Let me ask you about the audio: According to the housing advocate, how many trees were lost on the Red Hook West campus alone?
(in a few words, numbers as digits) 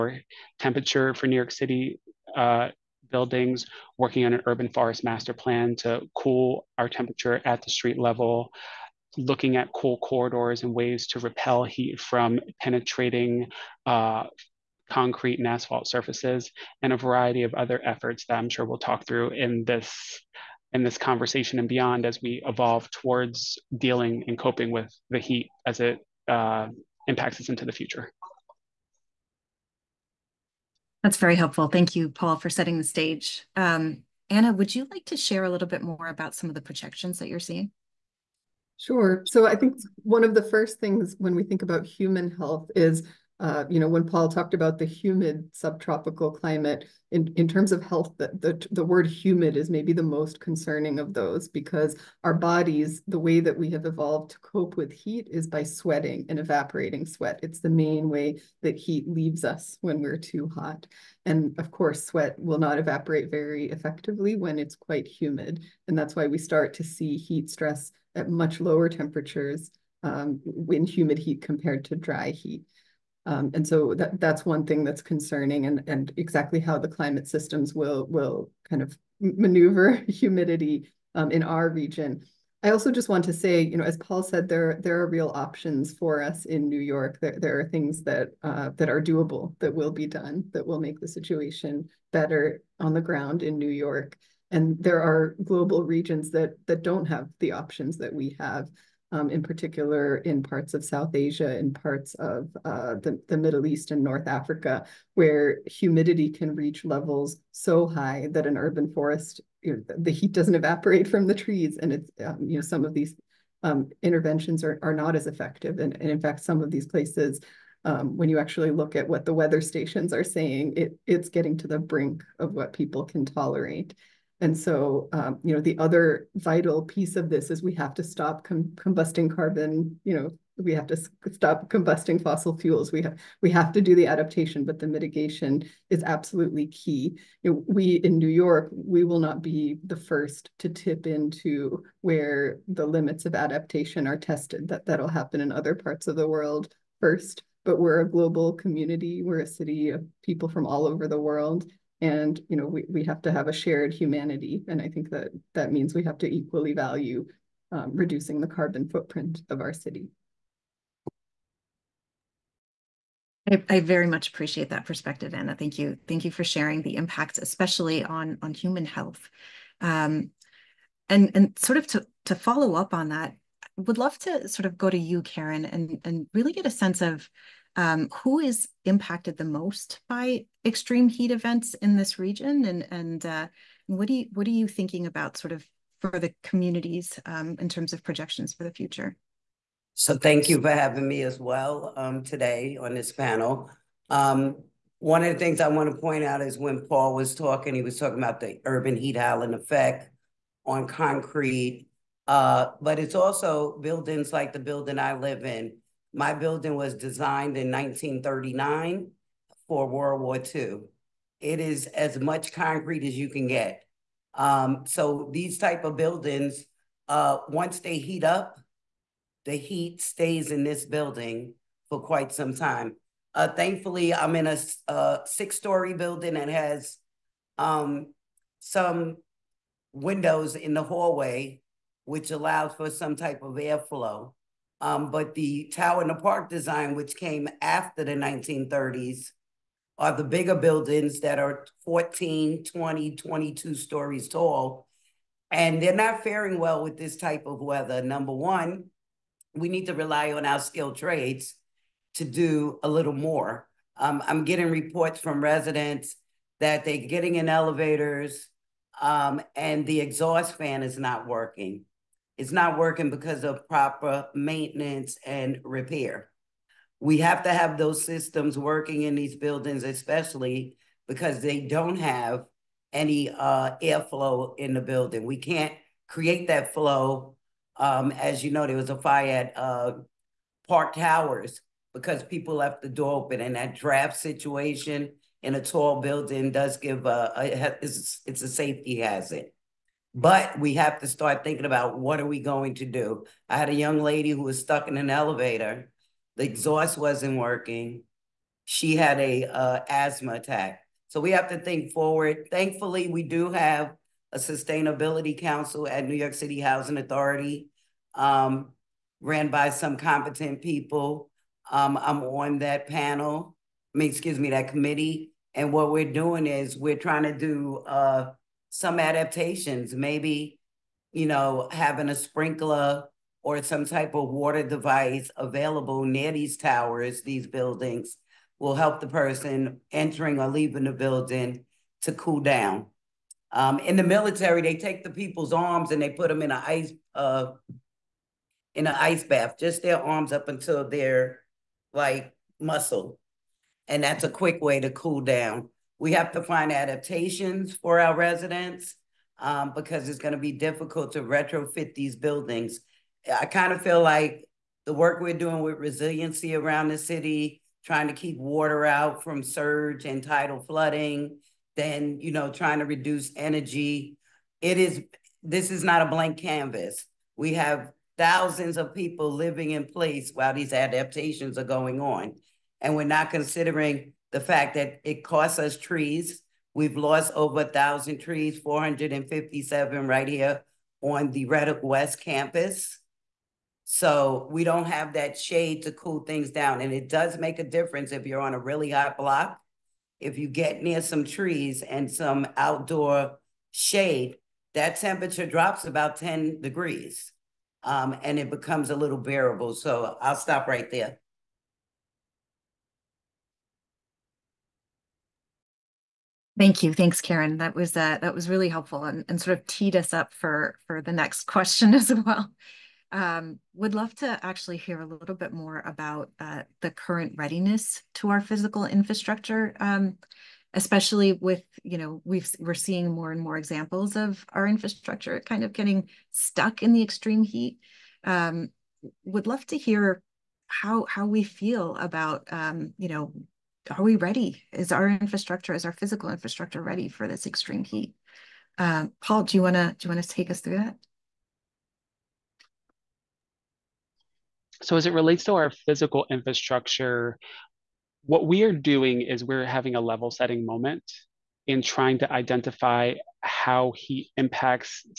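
457.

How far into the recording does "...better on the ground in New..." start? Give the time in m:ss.
1:32.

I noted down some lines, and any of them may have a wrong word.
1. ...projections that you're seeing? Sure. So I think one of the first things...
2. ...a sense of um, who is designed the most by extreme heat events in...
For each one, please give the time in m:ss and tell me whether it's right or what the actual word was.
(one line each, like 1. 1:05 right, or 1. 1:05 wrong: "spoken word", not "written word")
1. 0:36 right
2. 2:56 wrong: "impacted", not "designed".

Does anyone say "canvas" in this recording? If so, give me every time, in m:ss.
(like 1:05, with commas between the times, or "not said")
6:06.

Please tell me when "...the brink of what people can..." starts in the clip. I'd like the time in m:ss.
2:01.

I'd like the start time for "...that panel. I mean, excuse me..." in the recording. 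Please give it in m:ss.
5:12.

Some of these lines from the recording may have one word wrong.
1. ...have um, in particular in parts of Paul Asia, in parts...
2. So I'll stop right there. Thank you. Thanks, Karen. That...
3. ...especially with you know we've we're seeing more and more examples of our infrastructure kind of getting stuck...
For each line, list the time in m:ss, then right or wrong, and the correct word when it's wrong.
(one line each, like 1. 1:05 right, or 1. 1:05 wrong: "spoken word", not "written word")
1. 1:38 wrong: "South", not "Paul"
2. 6:39 right
3. 7:00 right.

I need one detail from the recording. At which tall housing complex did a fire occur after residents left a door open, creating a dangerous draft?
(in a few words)
Park Towers.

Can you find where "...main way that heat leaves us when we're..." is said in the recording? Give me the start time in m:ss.
0:57.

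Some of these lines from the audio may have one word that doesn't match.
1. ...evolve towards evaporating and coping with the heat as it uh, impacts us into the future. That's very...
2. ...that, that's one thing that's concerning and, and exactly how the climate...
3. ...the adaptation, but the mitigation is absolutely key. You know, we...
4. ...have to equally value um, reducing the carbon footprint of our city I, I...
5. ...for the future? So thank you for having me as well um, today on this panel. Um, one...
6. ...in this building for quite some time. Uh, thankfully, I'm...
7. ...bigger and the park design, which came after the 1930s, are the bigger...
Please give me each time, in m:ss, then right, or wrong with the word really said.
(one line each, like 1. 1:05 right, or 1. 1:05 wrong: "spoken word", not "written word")
1. 0:22 wrong: "dealing", not "evaporating"
2. 1:13 right
3. 2:13 right
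4. 2:36 right
5. 3:08 right
6. 3:40 right
7. 3:55 wrong: "tower", not "bigger".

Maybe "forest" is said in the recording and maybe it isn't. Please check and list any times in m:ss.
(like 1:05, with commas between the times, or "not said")
0:04, 1:48.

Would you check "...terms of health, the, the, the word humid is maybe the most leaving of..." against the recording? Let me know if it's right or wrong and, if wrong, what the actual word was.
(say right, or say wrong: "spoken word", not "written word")
wrong: "concerning", not "leaving".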